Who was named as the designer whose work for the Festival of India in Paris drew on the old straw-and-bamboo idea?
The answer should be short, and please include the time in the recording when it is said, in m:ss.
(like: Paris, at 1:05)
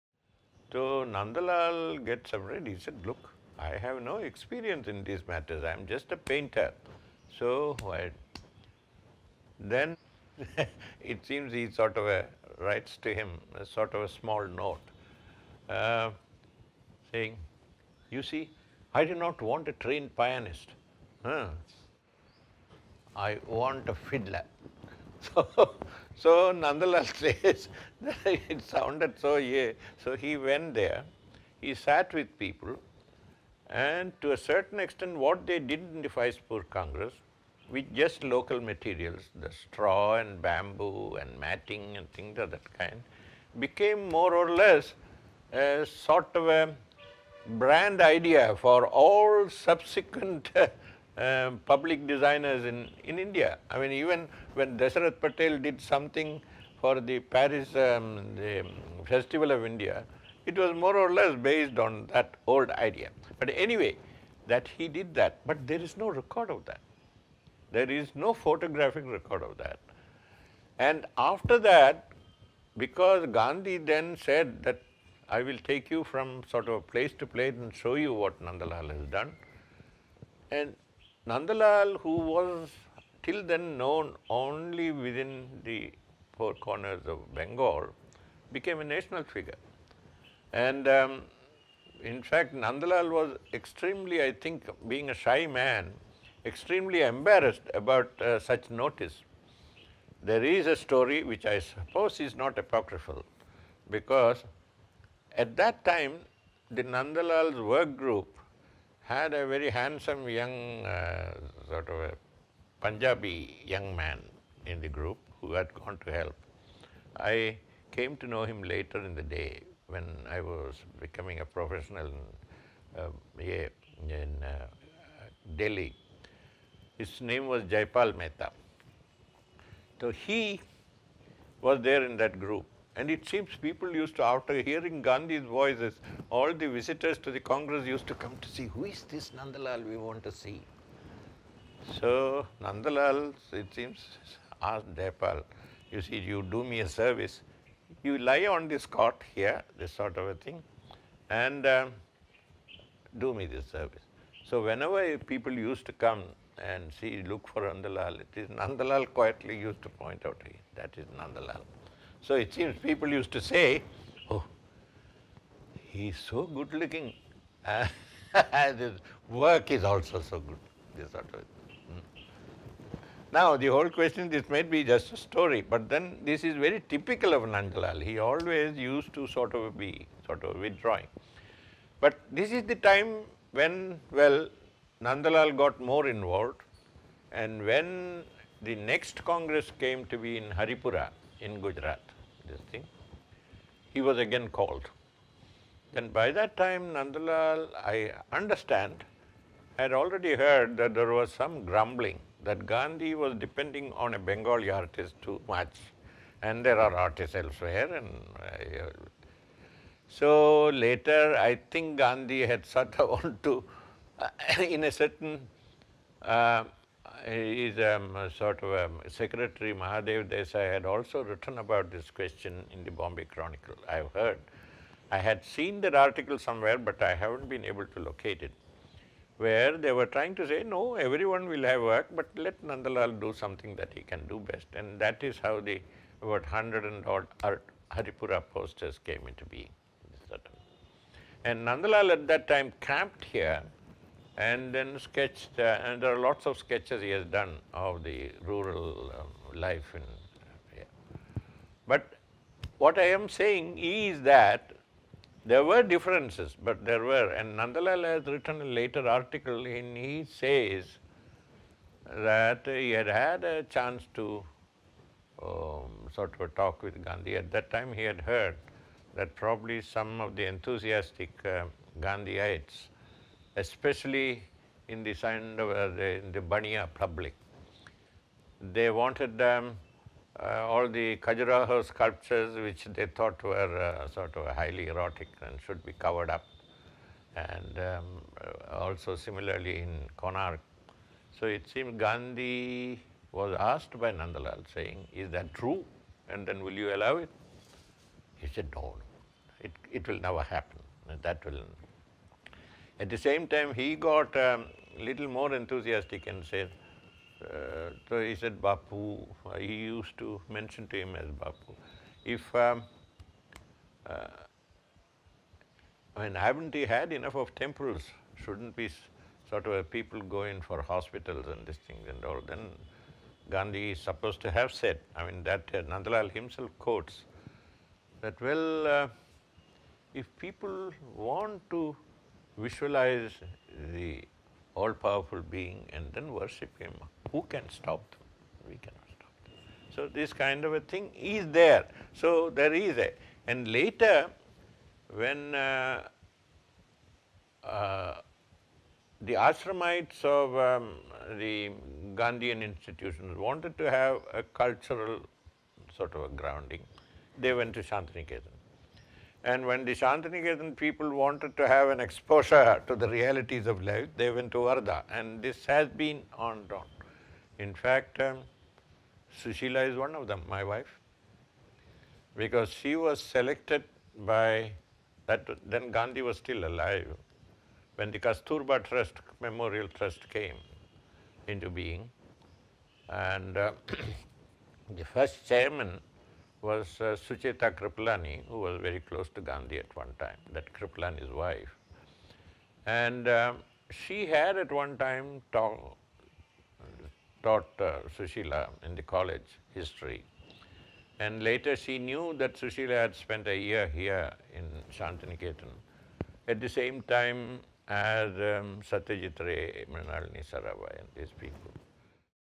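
Dashrath Patel, at 0:54.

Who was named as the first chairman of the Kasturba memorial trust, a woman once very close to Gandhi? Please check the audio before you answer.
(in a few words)
Sucheta Kriplani.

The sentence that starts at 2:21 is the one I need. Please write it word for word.
So Nandalal, it seems, asked Jaipal, you see, you do me a service.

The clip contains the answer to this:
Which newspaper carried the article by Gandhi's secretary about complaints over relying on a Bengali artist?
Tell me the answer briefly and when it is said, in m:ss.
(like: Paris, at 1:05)
Bombay Chronicle, at 3:42.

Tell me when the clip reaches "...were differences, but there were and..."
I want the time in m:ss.
4:15.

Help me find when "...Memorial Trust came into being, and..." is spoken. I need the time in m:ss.
6:19.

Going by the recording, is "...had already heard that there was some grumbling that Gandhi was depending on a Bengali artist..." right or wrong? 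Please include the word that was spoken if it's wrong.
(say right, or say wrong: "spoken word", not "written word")
right.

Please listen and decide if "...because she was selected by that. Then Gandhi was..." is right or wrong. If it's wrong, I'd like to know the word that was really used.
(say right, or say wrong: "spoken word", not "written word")
right.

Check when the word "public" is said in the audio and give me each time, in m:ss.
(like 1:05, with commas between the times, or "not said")
0:51, 4:36.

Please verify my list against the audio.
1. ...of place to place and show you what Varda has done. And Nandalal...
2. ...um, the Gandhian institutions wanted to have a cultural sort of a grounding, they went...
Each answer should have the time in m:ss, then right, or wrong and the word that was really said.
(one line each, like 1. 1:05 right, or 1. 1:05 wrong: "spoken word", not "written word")
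1. 1:16 wrong: "Nandalal", not "Varda"
2. 5:50 right.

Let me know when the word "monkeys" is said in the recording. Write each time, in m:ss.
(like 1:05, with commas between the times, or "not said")
not said.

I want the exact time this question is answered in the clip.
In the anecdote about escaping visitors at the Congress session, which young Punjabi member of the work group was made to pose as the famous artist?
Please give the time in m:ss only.
2:07.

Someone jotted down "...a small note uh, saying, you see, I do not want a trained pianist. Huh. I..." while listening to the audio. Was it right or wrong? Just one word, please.
right.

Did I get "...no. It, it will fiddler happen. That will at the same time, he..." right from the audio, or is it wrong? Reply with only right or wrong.
wrong.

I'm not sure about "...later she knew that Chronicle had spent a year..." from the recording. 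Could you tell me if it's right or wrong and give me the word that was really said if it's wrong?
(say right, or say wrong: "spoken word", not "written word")
wrong: "Sushila", not "Chronicle".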